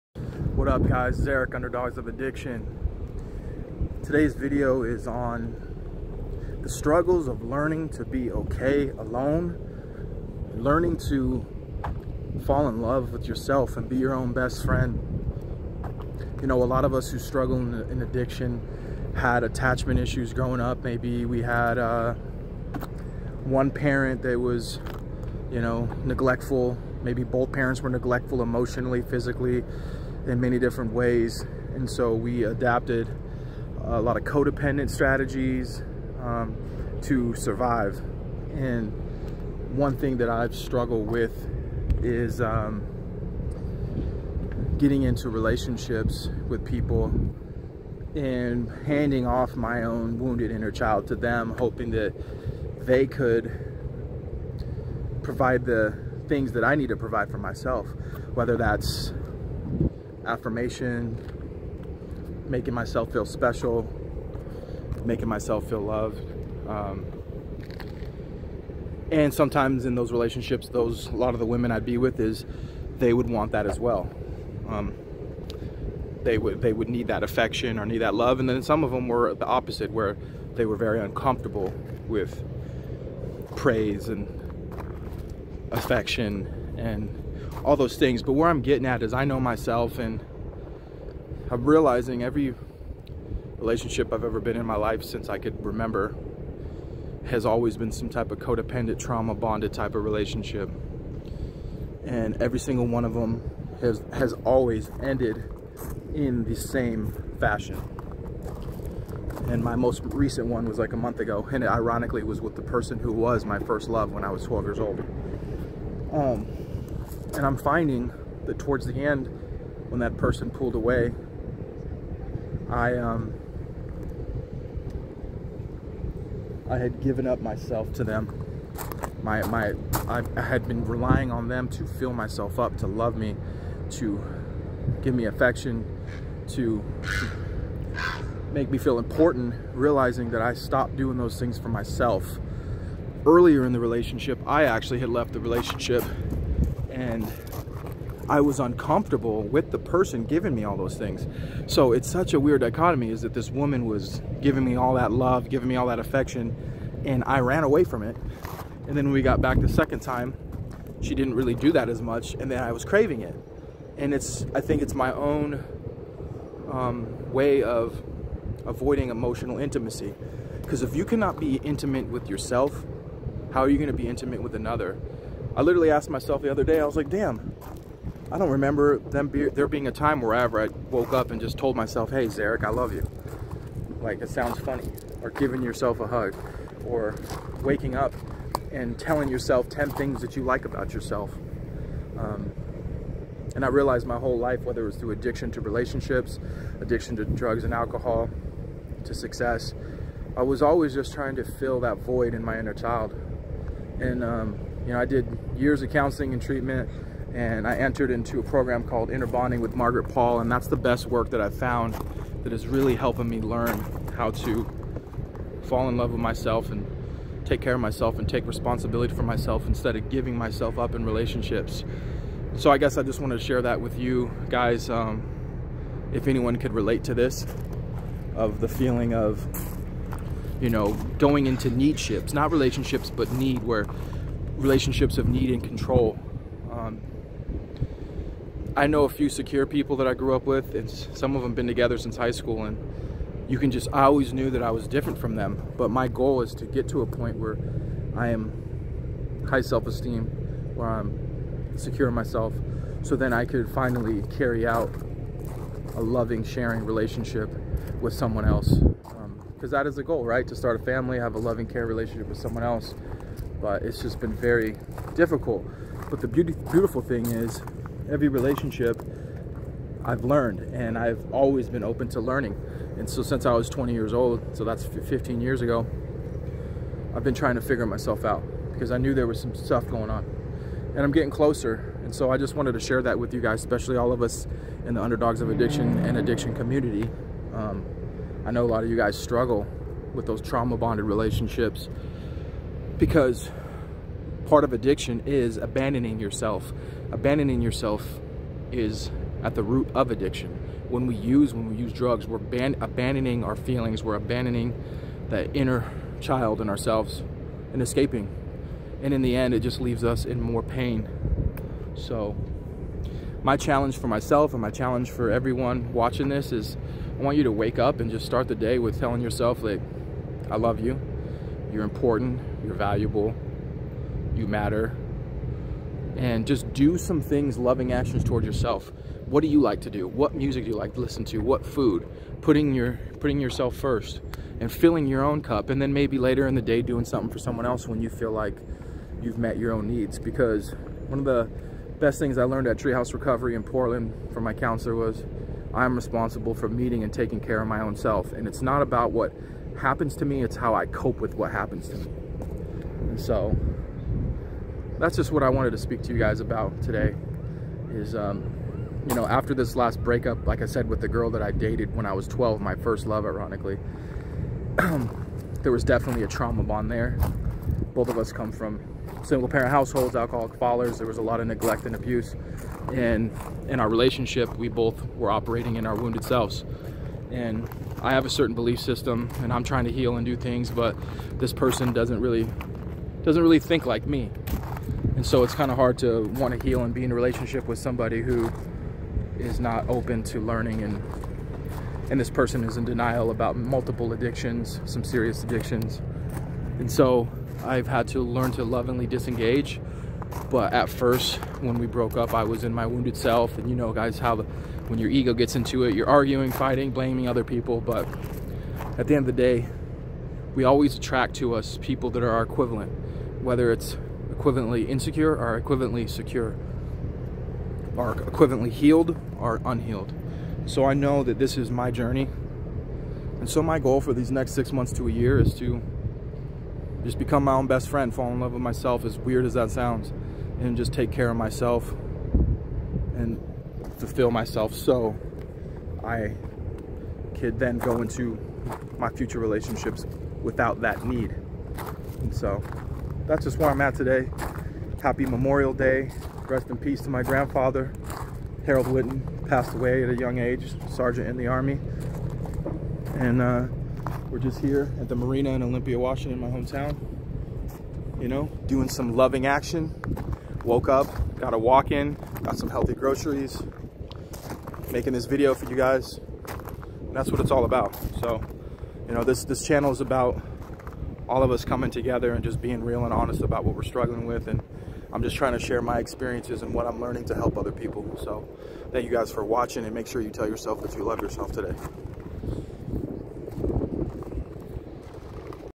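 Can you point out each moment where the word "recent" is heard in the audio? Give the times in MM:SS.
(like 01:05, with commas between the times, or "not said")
01:50.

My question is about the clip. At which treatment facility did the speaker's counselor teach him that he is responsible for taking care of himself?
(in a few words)
Treehouse Recovery.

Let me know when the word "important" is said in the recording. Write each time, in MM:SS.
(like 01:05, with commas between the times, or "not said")
02:18, 05:21.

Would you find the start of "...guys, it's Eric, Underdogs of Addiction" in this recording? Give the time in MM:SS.
00:00.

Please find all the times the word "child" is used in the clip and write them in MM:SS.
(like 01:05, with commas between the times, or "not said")
00:50, 03:22, 05:06.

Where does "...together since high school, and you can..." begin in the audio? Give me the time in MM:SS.
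04:01.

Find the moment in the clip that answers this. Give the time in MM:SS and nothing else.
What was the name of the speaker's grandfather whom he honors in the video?
07:28.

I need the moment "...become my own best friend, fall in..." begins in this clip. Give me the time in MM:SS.
07:07.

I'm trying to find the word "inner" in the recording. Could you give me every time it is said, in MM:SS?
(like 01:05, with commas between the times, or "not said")
00:50, 03:22, 03:29, 05:05.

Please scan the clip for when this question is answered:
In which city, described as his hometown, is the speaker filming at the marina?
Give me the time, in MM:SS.
07:35.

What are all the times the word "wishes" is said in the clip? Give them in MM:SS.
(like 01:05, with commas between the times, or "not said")
not said.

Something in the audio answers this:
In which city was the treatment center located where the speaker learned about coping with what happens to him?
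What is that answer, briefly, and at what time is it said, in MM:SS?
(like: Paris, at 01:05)
Portland, at 05:43.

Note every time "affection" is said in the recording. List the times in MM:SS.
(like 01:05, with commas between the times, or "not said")
01:17, 01:25, 02:15, 02:35.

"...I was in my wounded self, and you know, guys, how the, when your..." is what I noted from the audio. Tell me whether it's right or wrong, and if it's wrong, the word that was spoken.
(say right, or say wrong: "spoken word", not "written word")
right.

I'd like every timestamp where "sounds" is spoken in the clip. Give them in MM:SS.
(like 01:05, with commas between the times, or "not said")
03:04, 07:09.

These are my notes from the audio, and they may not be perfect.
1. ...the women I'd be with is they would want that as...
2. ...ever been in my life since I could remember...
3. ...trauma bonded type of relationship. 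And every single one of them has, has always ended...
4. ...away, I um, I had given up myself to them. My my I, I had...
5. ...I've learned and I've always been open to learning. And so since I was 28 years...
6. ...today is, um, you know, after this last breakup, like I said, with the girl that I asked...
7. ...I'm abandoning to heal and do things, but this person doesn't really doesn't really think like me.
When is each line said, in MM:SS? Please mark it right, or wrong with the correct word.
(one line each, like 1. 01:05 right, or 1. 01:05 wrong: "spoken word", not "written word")
1. 01:11 right
2. 01:34 right
3. 01:38 right
4. 02:00 right
5. 04:30 wrong: "20", not "28"
6. 05:56 wrong: "dated", not "asked"
7. 06:19 wrong: "trying", not "abandoning".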